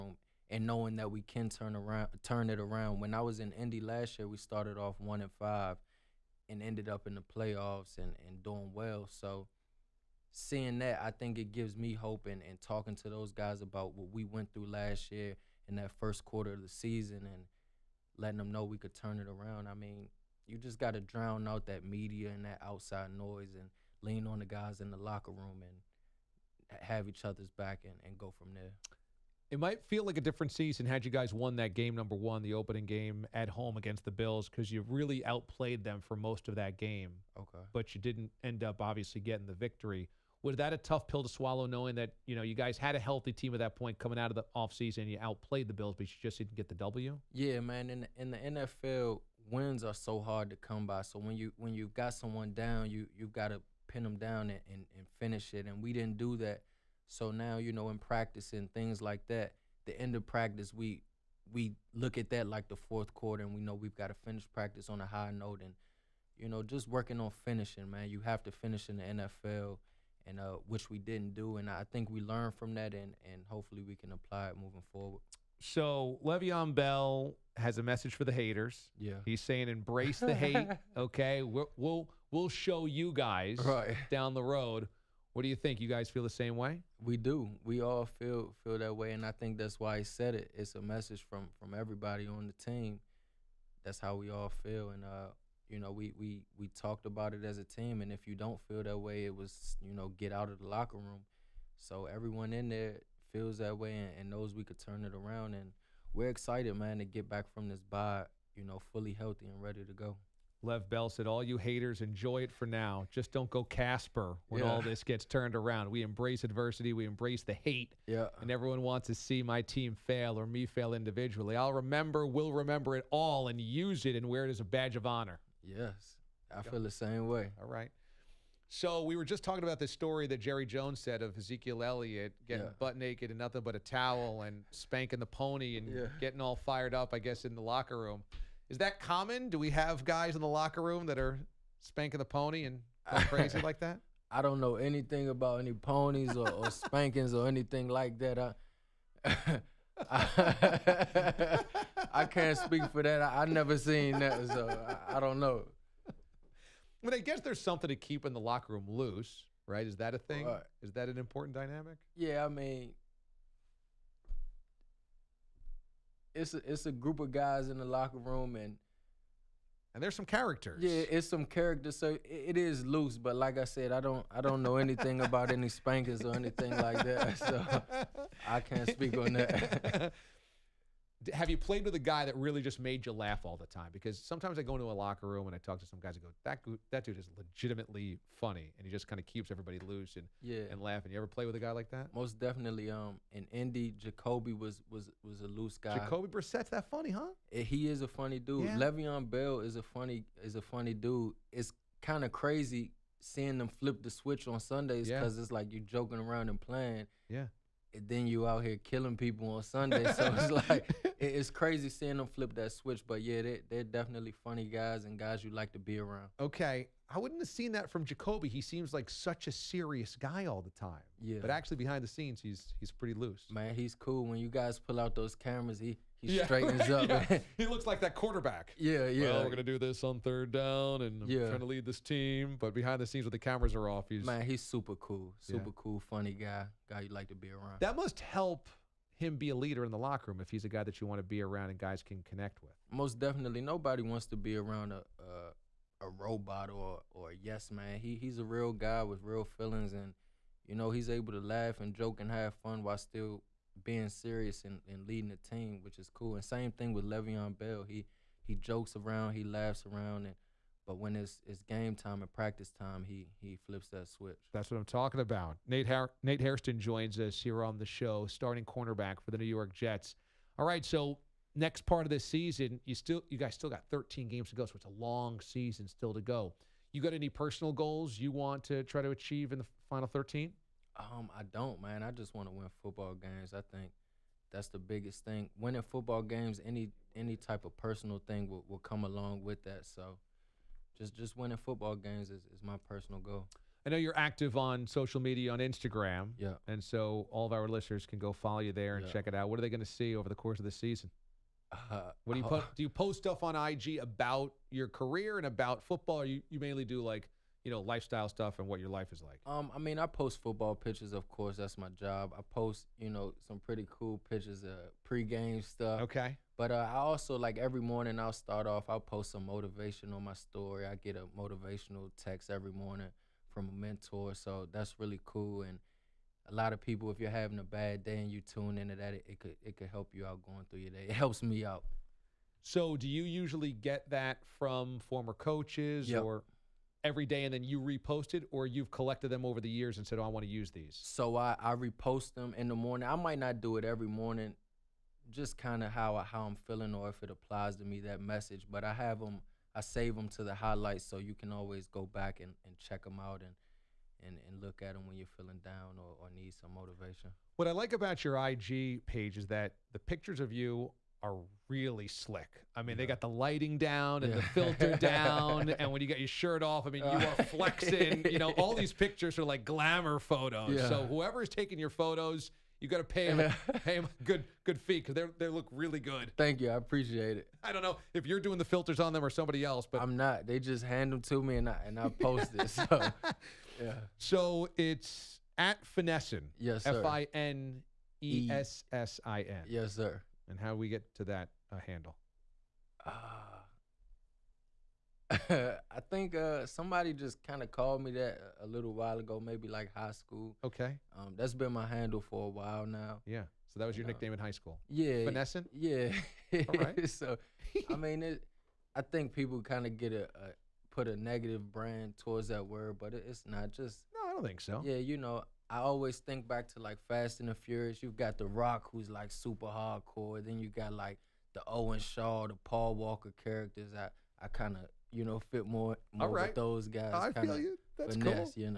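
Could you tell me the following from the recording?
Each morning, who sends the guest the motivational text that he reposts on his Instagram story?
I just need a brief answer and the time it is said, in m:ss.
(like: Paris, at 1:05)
A mentor, at 5:23.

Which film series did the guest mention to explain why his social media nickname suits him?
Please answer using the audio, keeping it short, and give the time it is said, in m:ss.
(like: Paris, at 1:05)
Fast and the Furious, at 6:57.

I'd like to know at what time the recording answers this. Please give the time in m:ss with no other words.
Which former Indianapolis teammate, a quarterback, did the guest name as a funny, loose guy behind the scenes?
3:15.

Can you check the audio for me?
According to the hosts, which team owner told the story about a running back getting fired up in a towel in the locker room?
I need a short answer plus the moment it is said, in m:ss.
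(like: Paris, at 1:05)
Jerry Jones, at 2:10.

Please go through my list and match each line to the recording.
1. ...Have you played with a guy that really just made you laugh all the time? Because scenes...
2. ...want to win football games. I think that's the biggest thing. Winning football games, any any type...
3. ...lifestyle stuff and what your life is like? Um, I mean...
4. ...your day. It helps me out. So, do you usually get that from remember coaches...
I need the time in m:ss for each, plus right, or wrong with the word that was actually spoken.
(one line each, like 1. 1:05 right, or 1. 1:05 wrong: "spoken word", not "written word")
1. 3:01 wrong: "sometimes", not "scenes"
2. 4:42 right
3. 5:07 right
4. 5:30 wrong: "former", not "remember".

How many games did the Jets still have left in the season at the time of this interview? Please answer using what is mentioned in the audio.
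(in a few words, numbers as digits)
13.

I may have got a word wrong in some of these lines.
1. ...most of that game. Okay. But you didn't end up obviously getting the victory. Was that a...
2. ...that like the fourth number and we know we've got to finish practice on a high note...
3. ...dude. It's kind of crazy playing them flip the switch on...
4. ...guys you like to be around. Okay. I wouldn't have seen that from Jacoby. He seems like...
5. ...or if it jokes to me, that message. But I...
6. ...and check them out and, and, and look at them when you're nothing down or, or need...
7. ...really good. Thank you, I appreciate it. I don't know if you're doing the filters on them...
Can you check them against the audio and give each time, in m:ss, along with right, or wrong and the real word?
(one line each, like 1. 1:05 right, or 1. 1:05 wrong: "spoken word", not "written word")
1. 0:36 right
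2. 1:02 wrong: "quarter", not "number"
3. 3:20 wrong: "seeing", not "playing"
4. 3:35 right
5. 5:46 wrong: "applies", not "jokes"
6. 5:52 wrong: "feeling", not "nothing"
7. 6:15 right.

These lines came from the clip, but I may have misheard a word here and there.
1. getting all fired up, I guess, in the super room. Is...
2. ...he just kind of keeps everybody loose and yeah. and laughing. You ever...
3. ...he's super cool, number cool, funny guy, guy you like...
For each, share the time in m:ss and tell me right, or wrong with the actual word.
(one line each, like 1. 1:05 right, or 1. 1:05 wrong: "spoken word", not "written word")
1. 2:16 wrong: "locker", not "super"
2. 3:08 right
3. 3:54 wrong: "super", not "number".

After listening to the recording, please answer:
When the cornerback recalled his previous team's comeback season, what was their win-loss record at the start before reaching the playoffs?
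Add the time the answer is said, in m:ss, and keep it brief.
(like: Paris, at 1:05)
1-5, at 0:04.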